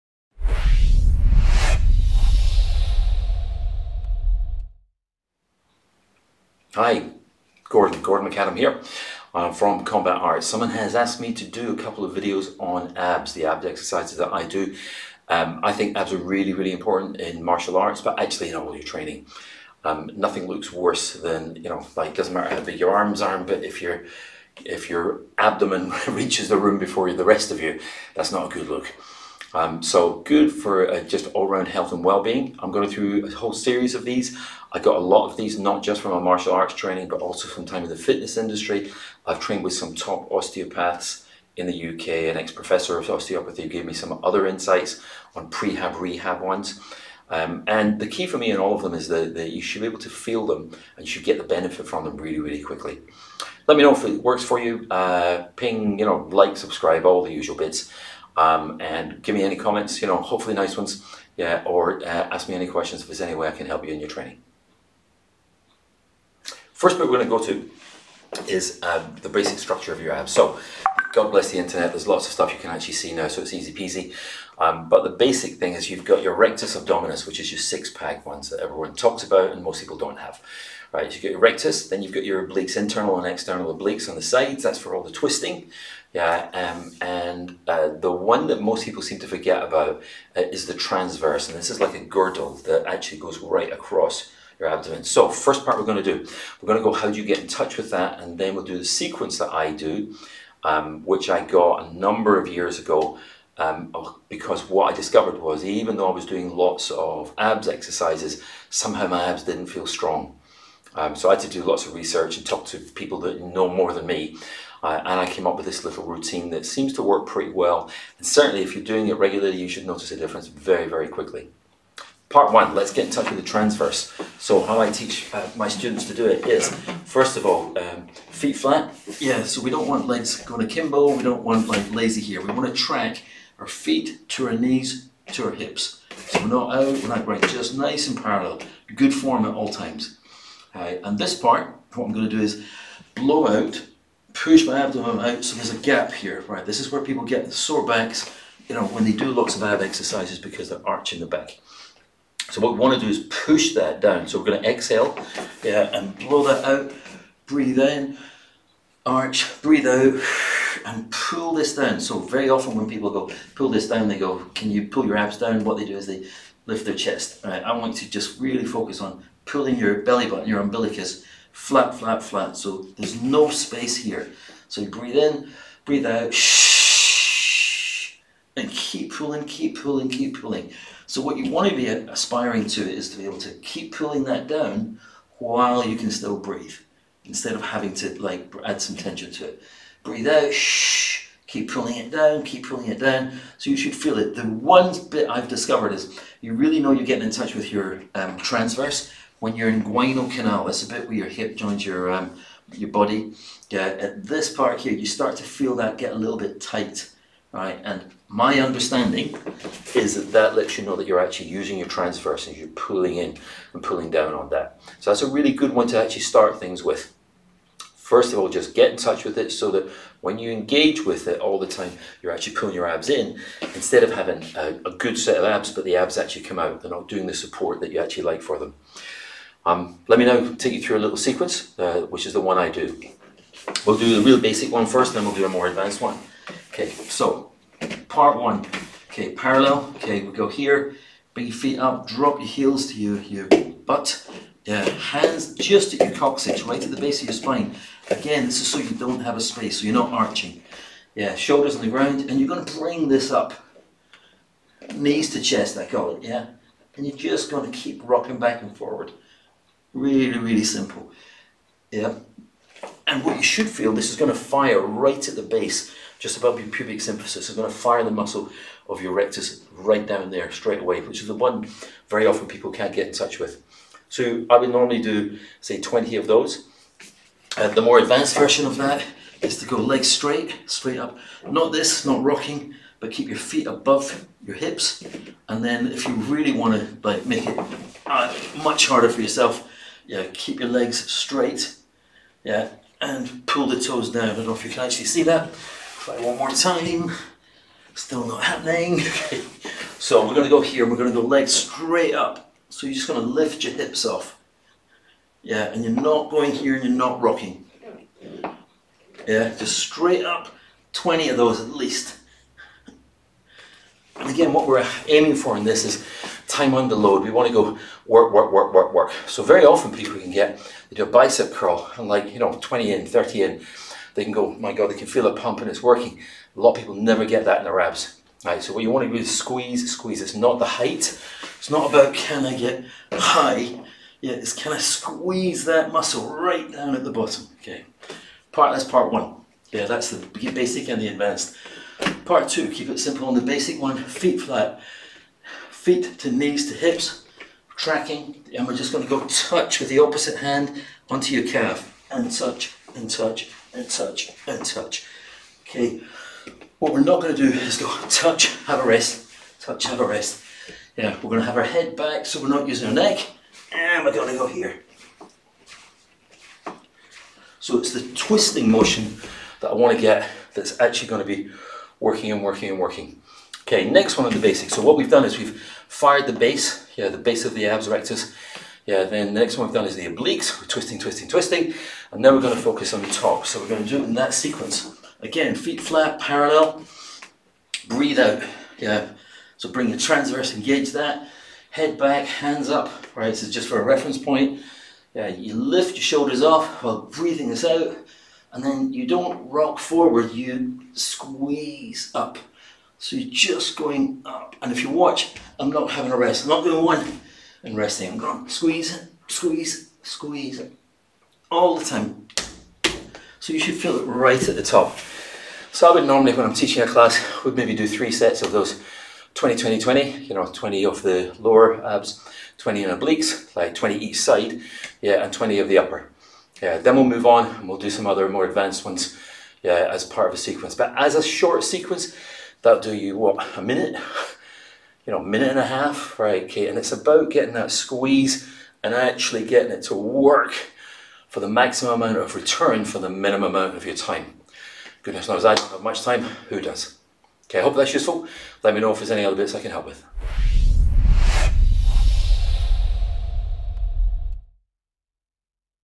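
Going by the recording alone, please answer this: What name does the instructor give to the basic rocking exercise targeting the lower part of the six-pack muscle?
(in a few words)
Knees to chest.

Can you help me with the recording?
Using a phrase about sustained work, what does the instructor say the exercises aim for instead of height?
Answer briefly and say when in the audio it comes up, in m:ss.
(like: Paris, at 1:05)
time under load, at 5:16.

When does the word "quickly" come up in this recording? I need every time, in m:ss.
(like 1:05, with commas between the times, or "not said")
0:52, 2:01.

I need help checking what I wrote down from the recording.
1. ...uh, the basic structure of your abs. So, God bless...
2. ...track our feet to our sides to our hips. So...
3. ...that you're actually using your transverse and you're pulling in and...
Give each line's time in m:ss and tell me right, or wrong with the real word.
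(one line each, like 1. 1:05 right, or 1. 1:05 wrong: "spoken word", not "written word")
1. 1:08 right
2. 2:12 wrong: "knees", not "sides"
3. 3:30 right.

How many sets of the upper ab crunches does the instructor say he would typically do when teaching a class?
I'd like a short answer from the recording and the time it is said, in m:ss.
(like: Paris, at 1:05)
3, at 6:57.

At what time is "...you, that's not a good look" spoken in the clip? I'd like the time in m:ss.
0:27.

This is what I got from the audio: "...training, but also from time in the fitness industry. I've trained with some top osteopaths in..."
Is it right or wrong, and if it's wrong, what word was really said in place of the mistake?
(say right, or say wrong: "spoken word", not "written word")
right.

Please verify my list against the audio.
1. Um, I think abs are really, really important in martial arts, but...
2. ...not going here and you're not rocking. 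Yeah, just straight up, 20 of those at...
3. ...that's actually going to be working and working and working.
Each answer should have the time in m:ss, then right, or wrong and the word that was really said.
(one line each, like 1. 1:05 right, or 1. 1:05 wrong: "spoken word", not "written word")
1. 0:15 right
2. 5:05 right
3. 6:10 right.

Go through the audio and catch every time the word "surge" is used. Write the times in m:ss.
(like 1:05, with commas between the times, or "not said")
not said.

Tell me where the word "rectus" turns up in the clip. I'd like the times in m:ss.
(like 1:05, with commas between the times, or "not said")
1:16, 1:21, 4:29, 6:17.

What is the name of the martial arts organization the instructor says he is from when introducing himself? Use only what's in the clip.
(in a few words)
Combat Arts.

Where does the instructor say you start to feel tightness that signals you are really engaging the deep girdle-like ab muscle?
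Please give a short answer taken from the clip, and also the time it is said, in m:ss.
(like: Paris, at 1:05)
inguinal canal, at 3:19.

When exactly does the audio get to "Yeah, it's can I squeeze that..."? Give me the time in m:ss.
5:34.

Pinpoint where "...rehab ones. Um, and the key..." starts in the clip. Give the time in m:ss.
0:45.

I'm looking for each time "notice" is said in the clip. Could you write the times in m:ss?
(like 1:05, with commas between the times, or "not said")
1:59.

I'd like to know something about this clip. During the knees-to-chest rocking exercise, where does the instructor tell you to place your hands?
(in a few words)
at your coccyx.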